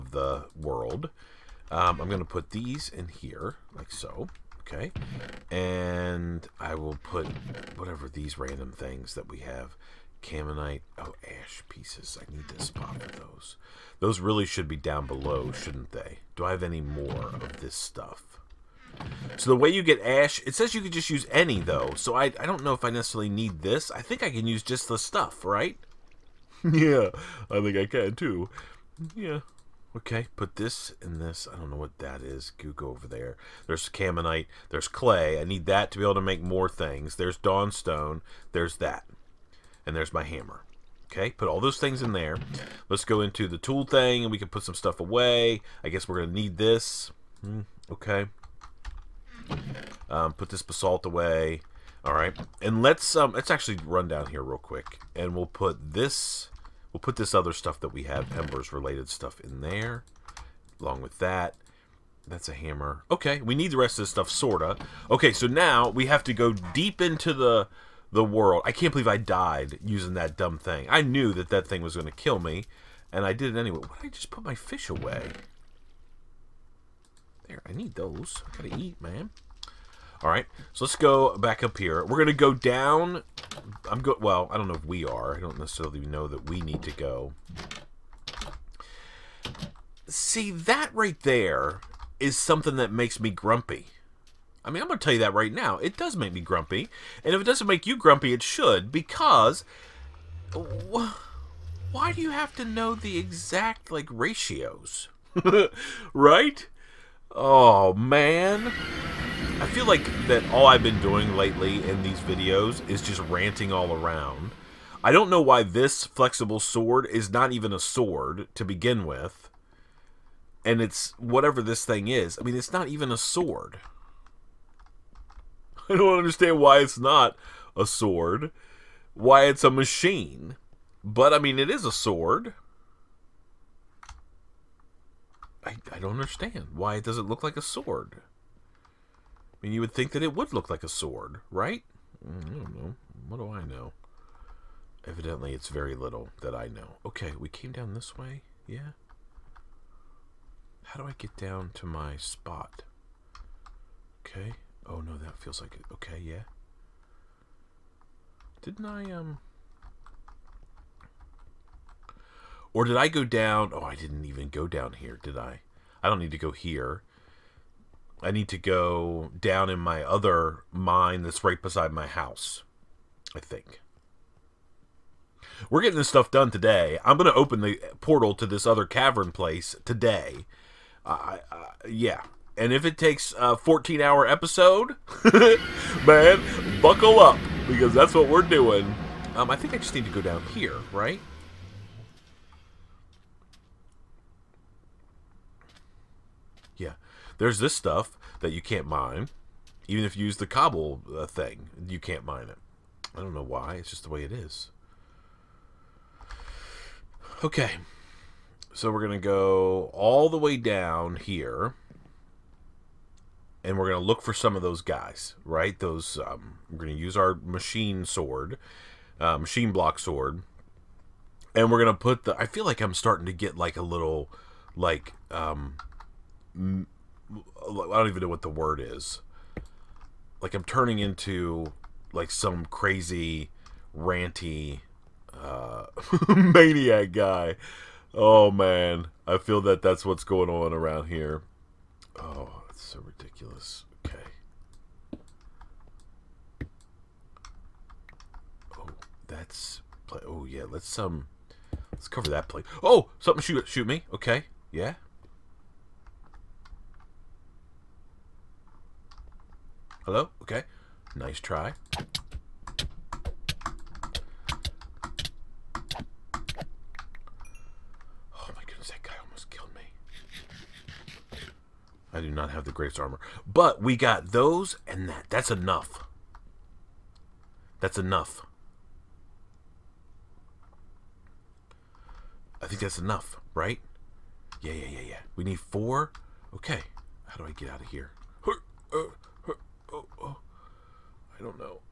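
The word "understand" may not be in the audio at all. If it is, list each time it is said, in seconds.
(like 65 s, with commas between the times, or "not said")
126 s, 136 s.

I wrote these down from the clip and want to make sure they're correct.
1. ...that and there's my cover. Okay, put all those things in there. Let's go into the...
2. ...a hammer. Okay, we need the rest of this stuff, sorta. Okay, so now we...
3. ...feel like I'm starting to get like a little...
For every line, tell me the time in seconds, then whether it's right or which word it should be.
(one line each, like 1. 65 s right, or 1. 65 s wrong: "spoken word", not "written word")
1. 38 s wrong: "hammer", not "cover"
2. 62 s right
3. 222 s right.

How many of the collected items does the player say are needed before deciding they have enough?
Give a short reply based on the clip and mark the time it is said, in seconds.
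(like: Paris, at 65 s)
4, at 285 s.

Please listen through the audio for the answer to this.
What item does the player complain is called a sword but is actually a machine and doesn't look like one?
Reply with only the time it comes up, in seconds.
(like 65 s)
116 s.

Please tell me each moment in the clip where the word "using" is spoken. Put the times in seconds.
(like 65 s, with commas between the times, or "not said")
69 s.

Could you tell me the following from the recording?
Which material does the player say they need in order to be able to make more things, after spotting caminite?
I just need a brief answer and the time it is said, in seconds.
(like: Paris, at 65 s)
Clay, at 34 s.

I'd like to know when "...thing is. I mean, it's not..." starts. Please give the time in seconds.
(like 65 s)
121 s.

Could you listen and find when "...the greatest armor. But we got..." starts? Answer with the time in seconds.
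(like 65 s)
272 s.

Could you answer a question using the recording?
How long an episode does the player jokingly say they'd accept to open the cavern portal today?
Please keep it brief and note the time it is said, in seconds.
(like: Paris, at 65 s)
14 hour, at 183 s.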